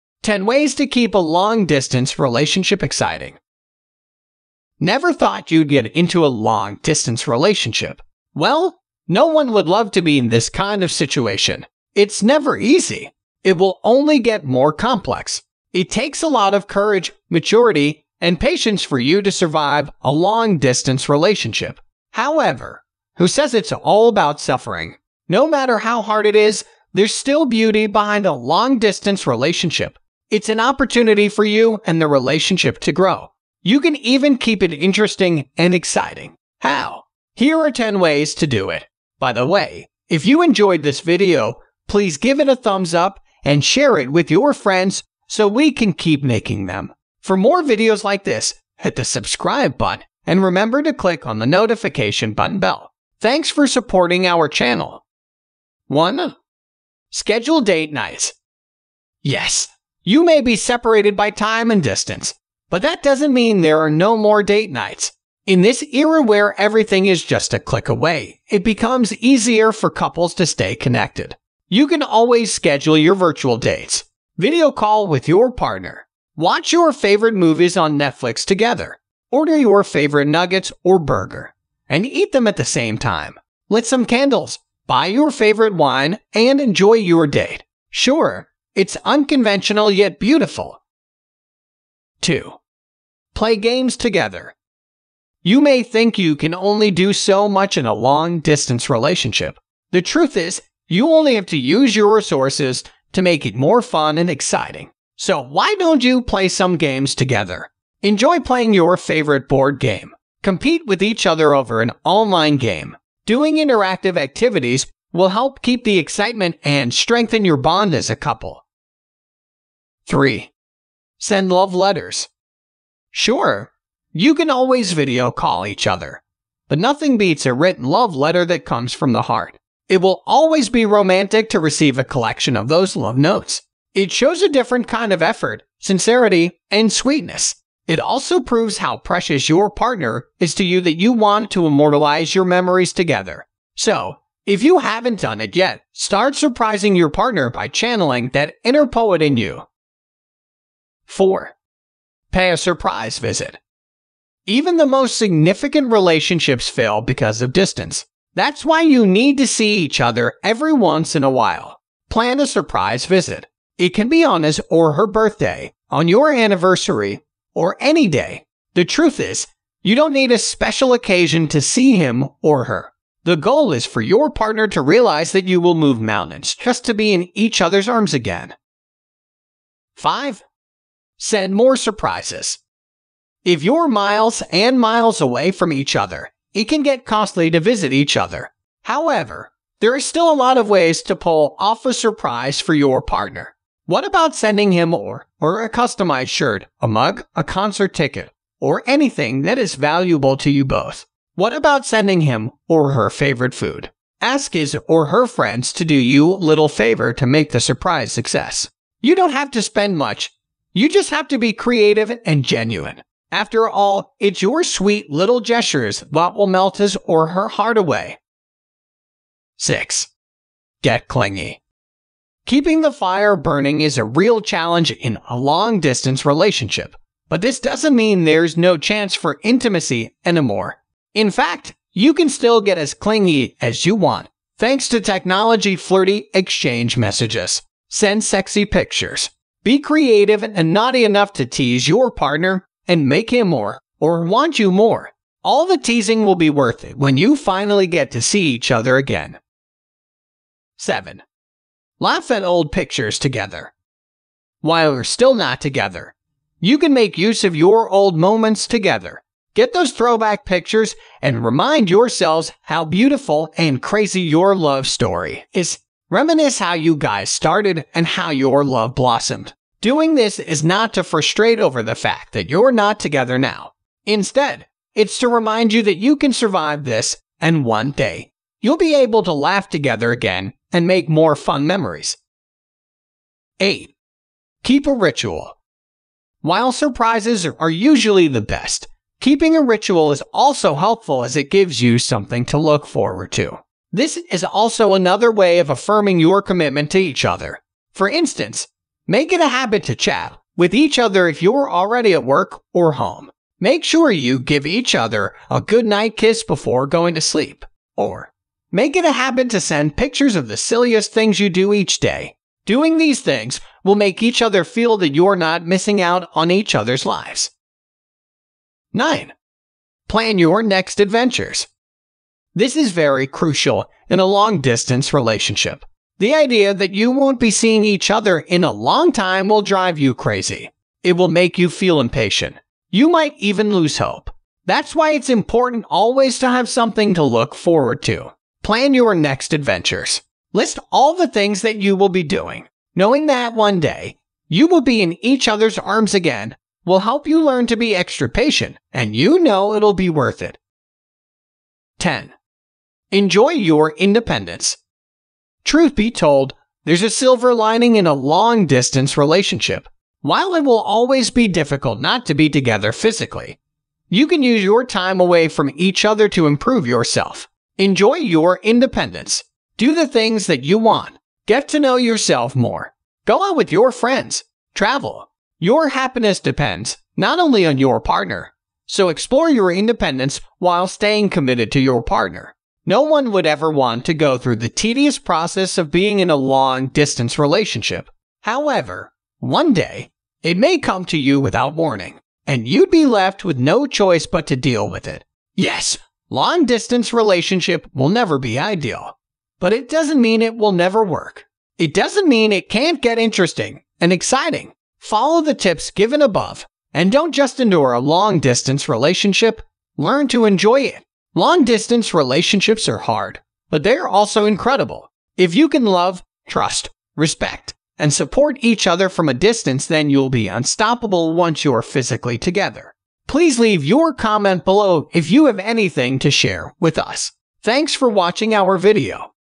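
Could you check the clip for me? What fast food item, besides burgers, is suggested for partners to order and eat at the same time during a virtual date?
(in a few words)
Nuggets.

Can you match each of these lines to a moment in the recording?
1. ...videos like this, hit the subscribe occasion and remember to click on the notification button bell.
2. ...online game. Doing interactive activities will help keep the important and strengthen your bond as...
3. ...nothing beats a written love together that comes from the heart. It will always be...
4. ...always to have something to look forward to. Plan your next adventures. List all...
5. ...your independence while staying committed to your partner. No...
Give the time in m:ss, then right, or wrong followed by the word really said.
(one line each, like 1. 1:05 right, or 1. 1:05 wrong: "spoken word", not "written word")
1. 0:47 wrong: "button", not "occasion"
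2. 1:52 wrong: "excitement", not "important"
3. 2:06 wrong: "letter", not "together"
4. 5:35 right
5. 6:19 right.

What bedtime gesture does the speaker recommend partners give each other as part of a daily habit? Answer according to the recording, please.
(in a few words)
Good night kiss.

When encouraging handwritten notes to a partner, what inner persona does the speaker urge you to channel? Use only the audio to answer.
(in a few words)
Inner poet.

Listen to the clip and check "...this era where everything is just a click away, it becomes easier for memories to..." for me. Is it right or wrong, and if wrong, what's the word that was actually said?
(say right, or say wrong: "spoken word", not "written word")
wrong: "couples", not "memories".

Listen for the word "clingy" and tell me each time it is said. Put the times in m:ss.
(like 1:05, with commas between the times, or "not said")
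3:41, 3:52.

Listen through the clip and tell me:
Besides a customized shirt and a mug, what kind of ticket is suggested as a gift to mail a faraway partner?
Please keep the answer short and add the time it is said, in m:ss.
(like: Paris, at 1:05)
Concert ticket, at 3:17.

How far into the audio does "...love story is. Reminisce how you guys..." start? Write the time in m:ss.
4:24.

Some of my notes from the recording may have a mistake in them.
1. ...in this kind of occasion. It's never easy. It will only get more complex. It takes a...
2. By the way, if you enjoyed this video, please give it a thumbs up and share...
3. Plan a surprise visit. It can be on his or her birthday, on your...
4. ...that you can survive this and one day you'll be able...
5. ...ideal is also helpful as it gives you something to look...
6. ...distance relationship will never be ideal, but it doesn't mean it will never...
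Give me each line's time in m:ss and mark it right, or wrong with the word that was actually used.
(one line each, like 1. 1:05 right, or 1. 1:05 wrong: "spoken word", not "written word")
1. 0:10 wrong: "situation", not "occasion"
2. 0:39 right
3. 2:42 right
4. 4:35 right
5. 4:49 wrong: "ritual", not "ideal"
6. 6:36 right.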